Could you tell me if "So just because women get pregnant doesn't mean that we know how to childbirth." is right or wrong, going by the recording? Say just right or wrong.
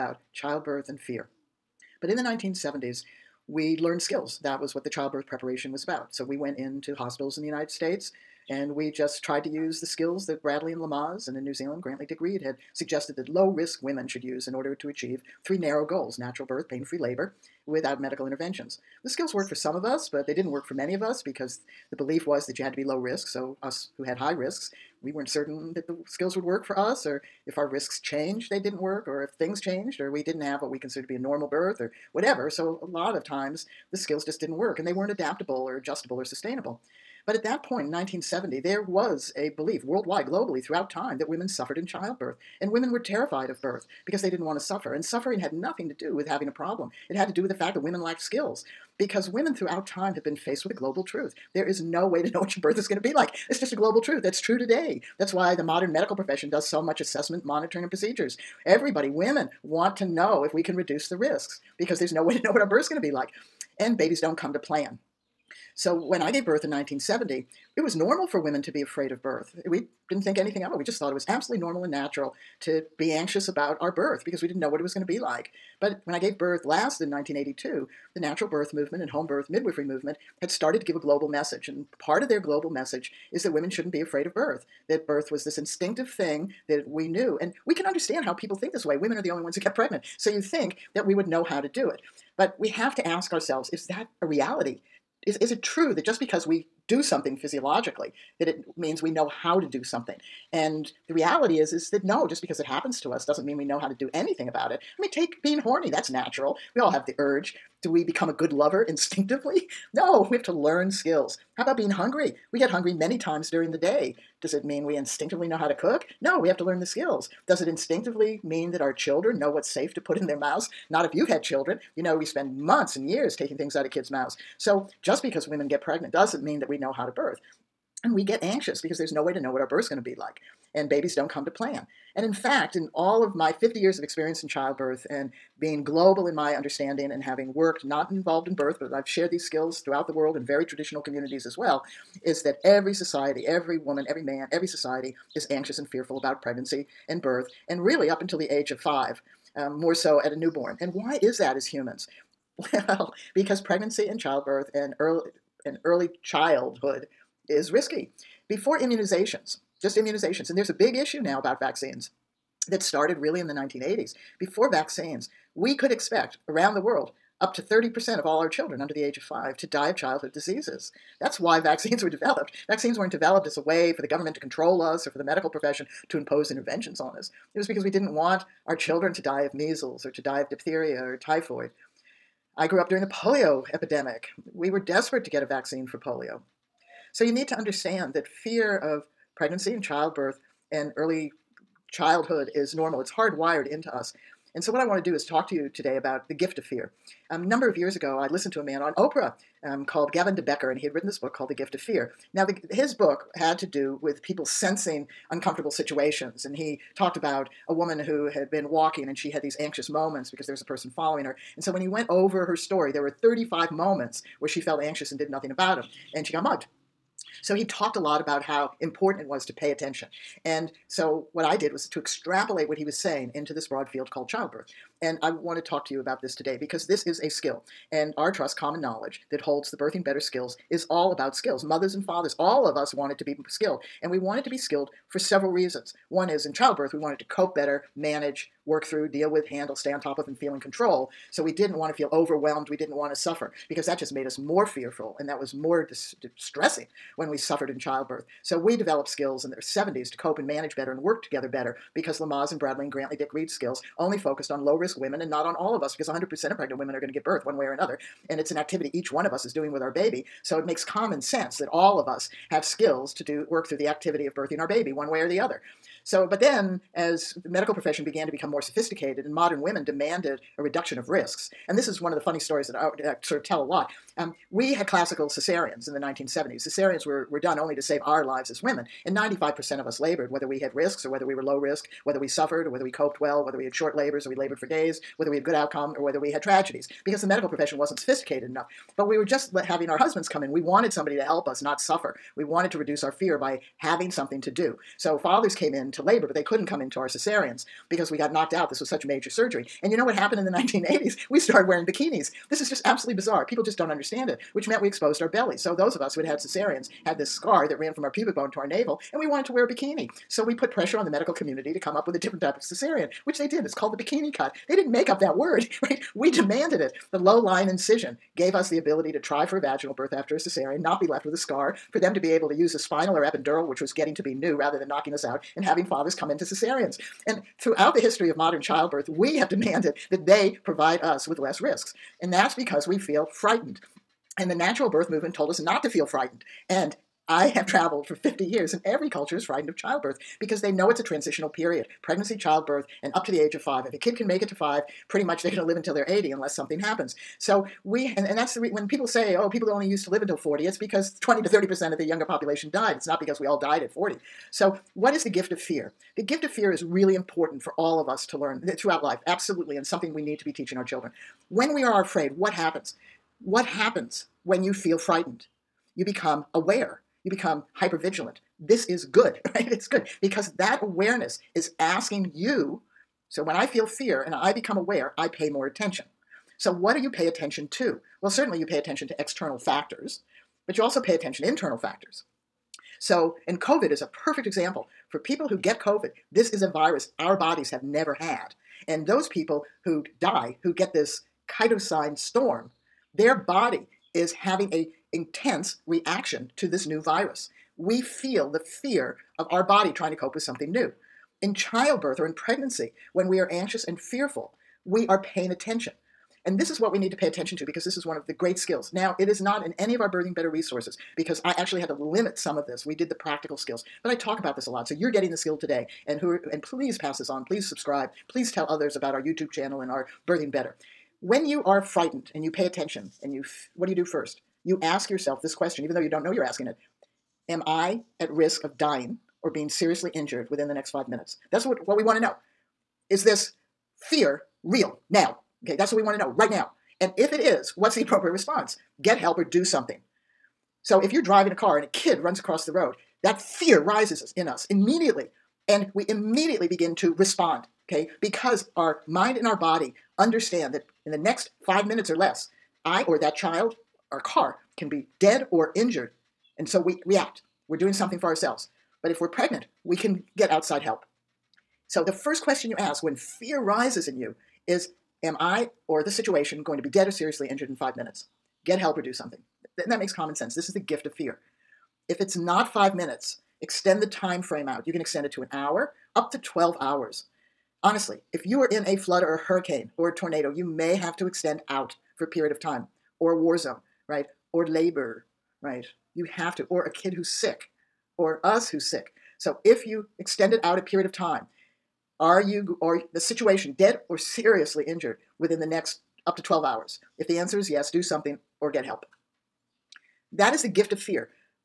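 wrong.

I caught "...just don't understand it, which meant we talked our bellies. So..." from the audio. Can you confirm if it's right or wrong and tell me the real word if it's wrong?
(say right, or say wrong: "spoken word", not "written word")
wrong: "exposed", not "talked".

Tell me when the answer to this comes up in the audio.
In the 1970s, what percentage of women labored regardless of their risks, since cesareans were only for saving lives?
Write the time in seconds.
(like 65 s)
279 s.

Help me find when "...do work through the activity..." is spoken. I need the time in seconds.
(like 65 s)
263 s.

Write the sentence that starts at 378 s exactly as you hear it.
Well, certainly you pay attention to external factors, but you also pay attention to internal factors.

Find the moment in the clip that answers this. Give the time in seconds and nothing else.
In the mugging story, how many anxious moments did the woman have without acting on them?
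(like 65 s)
213 s.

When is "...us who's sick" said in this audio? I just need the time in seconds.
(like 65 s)
488 s.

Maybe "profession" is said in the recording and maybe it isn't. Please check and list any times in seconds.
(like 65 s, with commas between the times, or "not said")
56 s, 175 s, 267 s, 287 s.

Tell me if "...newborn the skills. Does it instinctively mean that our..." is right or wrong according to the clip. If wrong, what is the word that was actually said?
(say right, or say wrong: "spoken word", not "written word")
wrong: "learn", not "newborn".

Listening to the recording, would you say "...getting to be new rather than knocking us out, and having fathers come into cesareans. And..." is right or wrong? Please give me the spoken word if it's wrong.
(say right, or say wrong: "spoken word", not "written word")
right.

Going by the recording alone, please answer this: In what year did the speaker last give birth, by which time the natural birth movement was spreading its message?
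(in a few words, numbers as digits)
1982.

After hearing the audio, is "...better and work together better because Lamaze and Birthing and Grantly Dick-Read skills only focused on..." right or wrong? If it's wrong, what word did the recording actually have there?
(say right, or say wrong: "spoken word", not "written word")
wrong: "Bradley", not "Birthing".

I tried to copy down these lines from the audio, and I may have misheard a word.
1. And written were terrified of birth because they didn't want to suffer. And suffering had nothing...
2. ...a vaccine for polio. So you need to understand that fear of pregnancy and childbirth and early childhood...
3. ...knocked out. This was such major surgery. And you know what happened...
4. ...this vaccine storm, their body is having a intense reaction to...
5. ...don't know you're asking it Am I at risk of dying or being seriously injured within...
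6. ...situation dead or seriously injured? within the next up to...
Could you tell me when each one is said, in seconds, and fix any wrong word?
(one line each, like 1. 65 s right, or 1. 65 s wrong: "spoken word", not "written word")
1. 42 s wrong: "women", not "written"
2. 185 s right
3. 298 s right
4. 390 s wrong: "cytokine", not "vaccine"
5. 426 s right
6. 493 s right.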